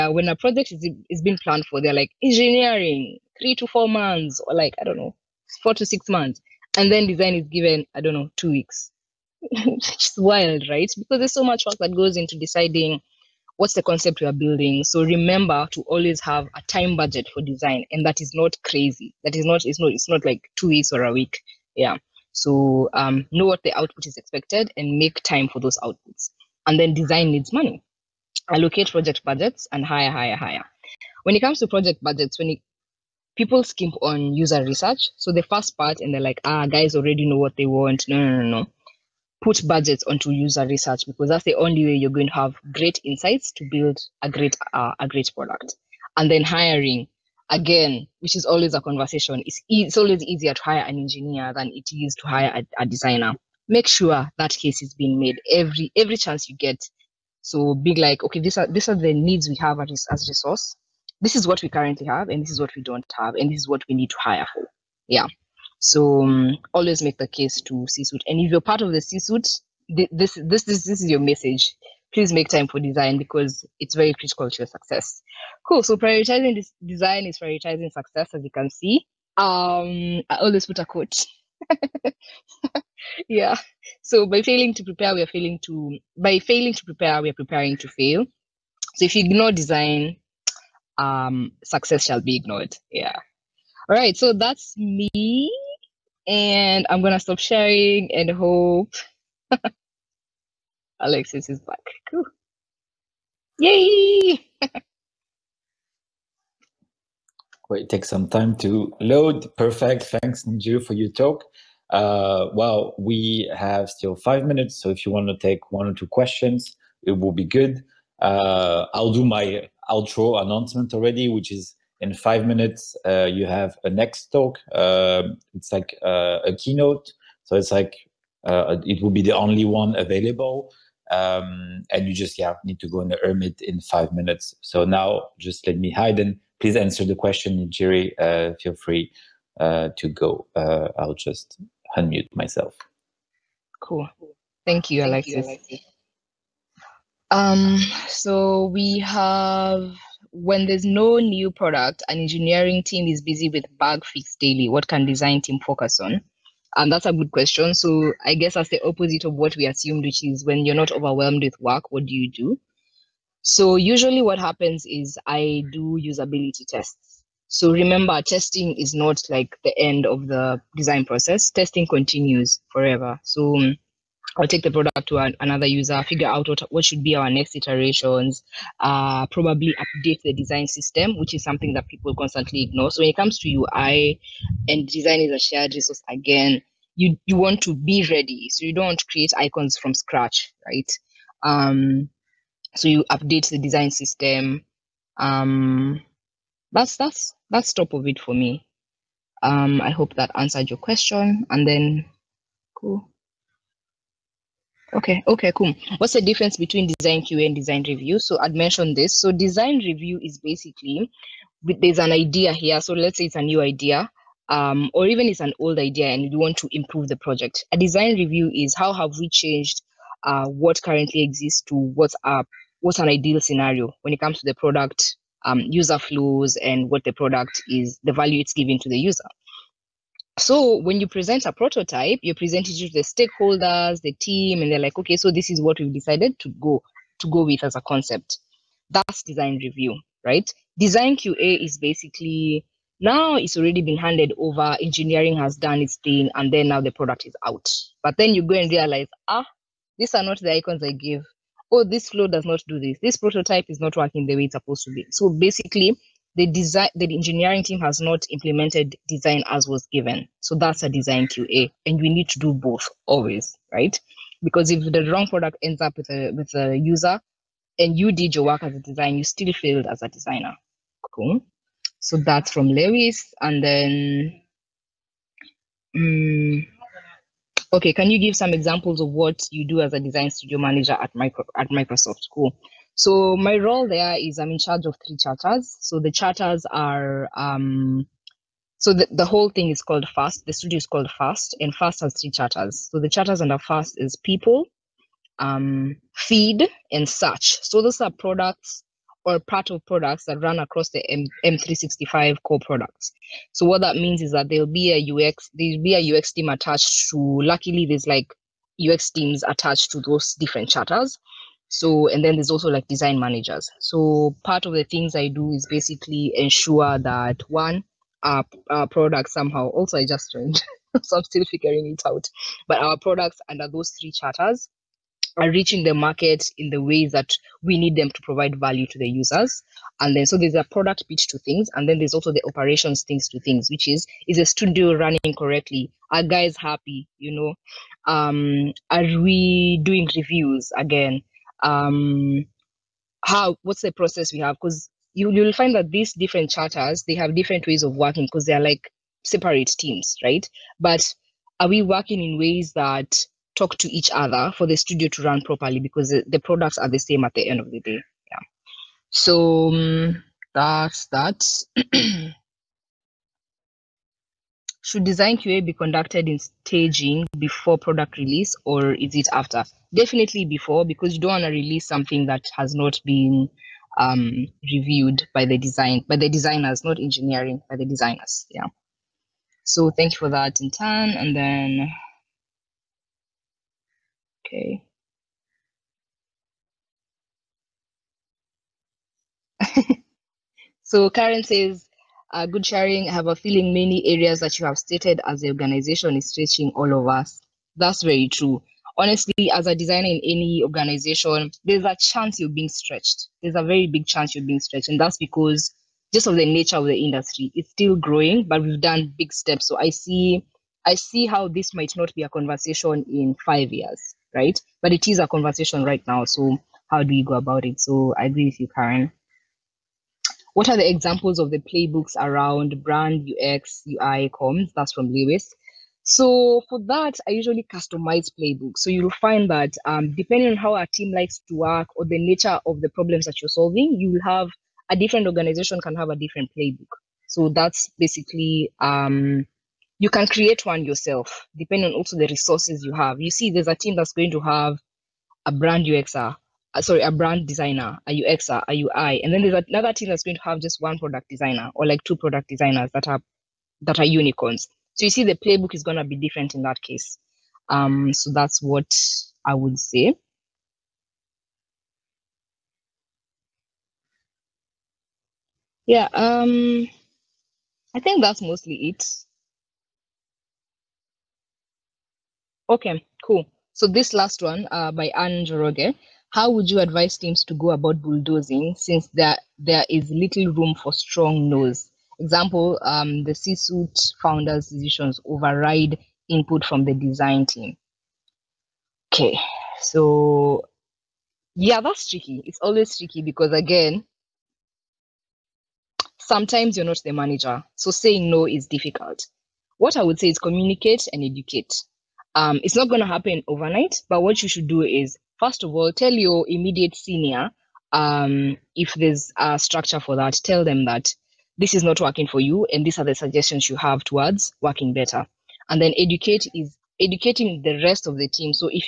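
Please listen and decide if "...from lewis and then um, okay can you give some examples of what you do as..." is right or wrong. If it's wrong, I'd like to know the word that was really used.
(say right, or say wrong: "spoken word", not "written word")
right.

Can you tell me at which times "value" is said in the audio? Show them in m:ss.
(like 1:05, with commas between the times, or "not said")
3:48, 5:28.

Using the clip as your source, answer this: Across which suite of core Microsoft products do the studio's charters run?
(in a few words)
M365.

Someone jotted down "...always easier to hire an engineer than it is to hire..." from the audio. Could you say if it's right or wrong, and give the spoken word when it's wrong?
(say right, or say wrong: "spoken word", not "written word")
right.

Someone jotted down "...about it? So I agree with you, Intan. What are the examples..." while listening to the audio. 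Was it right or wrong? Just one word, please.
wrong.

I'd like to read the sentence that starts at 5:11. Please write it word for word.
So, and then there's also like design managers.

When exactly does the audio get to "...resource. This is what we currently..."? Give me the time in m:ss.
1:00.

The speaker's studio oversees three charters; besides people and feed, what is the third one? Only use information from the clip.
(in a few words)
search.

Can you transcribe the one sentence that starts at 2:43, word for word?
So usually what happens is I do usability tests.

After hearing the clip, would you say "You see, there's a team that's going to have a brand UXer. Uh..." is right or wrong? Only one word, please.
right.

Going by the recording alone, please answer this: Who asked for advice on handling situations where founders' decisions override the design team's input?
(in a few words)
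Anne Njoroge.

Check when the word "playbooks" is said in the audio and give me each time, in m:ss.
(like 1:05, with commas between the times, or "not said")
7:01, 7:08, 7:16, 7:35.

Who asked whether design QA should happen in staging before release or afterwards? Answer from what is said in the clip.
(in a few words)
Intan.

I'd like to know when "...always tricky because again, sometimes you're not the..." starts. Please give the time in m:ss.
8:12.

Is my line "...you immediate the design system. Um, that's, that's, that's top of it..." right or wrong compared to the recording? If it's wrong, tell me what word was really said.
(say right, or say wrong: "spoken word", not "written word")
wrong: "update", not "immediate".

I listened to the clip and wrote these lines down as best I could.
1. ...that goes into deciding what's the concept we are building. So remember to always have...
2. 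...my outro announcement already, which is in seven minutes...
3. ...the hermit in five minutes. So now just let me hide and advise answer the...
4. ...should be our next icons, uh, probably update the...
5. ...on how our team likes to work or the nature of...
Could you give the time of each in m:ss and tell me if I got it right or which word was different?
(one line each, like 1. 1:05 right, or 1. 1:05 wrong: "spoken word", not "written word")
1. 0:11 right
2. 1:59 wrong: "five", not "seven"
3. 2:13 wrong: "please", not "advise"
4. 2:56 wrong: "iterations", not "icons"
5. 7:10 right.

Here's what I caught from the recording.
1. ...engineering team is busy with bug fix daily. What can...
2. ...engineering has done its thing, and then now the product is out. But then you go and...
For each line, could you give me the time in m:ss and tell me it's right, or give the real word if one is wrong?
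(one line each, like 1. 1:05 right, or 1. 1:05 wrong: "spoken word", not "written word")
1. 2:32 right
2. 4:04 right.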